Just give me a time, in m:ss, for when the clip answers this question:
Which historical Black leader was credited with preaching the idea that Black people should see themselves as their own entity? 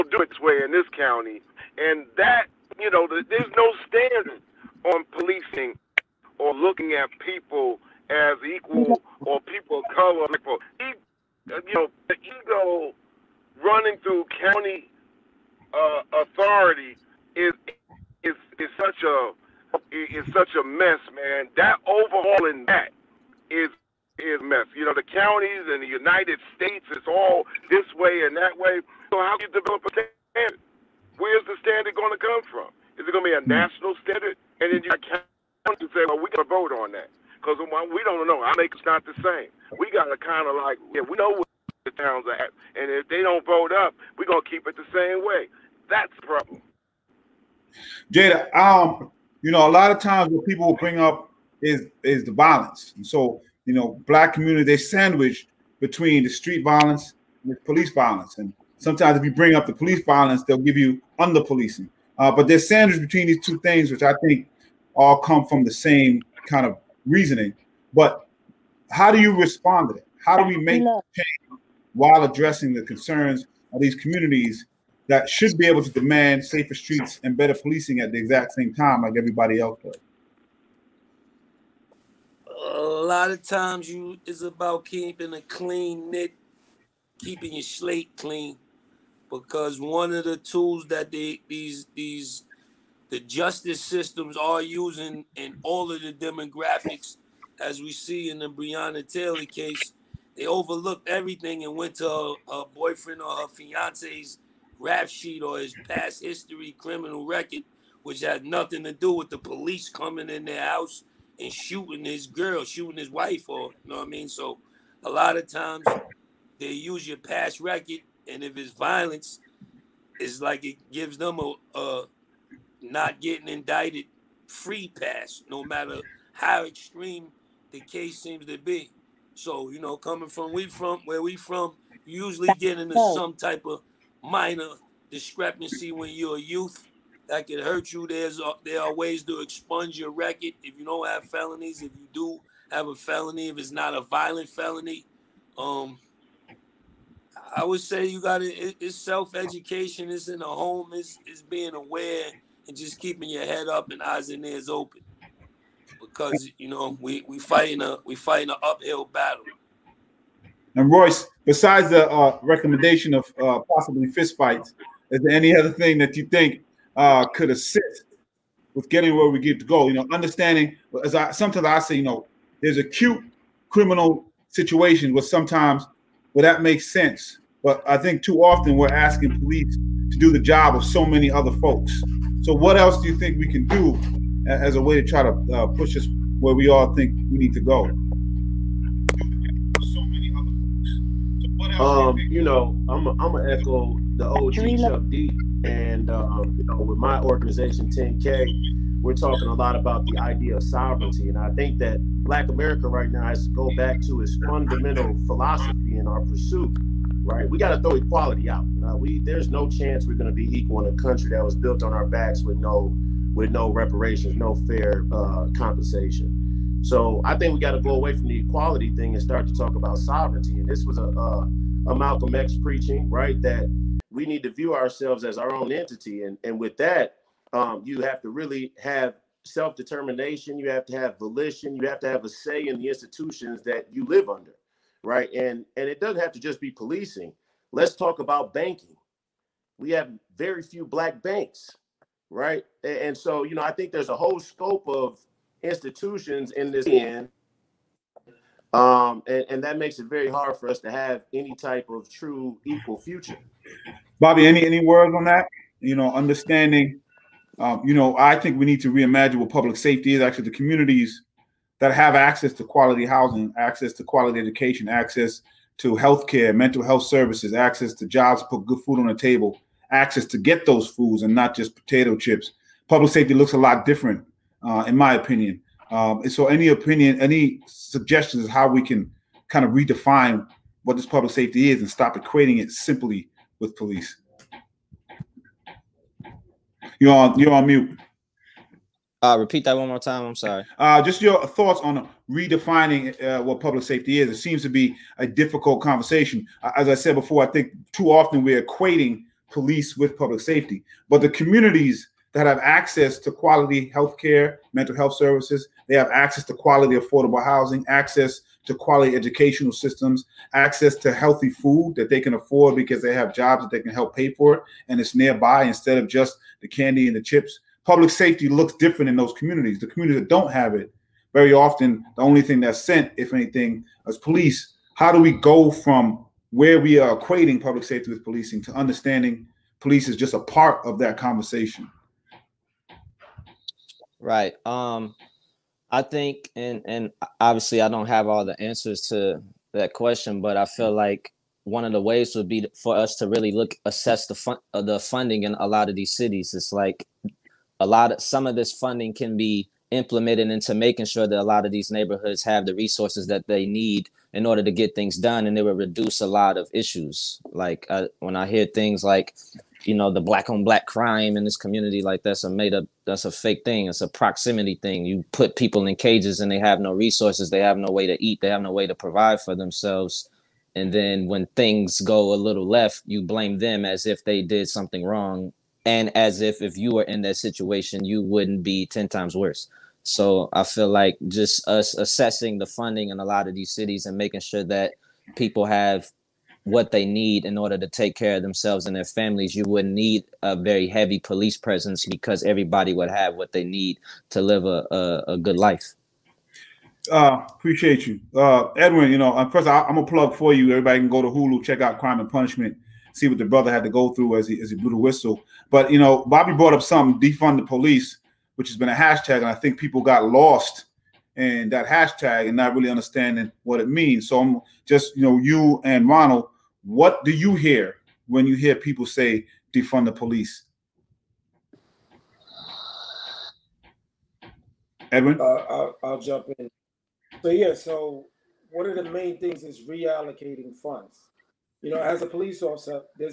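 3:41.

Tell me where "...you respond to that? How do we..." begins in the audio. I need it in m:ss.
1:09.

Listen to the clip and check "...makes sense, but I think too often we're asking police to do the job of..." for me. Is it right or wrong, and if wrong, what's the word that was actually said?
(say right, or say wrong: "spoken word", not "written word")
right.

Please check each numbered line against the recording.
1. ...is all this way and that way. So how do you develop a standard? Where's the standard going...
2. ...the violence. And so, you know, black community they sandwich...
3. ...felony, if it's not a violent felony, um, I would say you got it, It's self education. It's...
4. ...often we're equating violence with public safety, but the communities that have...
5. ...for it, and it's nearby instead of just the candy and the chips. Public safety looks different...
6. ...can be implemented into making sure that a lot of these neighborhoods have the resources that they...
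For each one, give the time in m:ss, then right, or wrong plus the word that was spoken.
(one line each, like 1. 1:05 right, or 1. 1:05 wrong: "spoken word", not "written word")
1. 0:26 right
2. 0:52 right
3. 2:22 right
4. 4:58 wrong: "police", not "violence"
5. 5:14 right
6. 5:49 right.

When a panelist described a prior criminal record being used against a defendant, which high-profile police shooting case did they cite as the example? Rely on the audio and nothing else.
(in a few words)
Breonna Taylor.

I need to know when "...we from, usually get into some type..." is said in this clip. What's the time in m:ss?
2:11.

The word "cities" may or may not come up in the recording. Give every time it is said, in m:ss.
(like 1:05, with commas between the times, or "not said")
5:46, 6:23.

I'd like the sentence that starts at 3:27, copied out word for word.
Right, we got to throw equality out.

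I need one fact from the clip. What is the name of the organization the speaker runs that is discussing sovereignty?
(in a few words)
10K.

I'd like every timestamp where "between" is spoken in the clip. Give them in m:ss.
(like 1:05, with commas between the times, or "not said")
0:55, 1:03.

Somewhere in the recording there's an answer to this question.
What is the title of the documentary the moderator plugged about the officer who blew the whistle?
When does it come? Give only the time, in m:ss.
6:41.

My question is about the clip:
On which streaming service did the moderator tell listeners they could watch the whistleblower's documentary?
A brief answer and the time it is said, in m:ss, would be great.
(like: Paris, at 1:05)
Hulu, at 6:41.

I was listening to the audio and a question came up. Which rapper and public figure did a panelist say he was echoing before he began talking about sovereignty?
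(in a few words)
Chuck D.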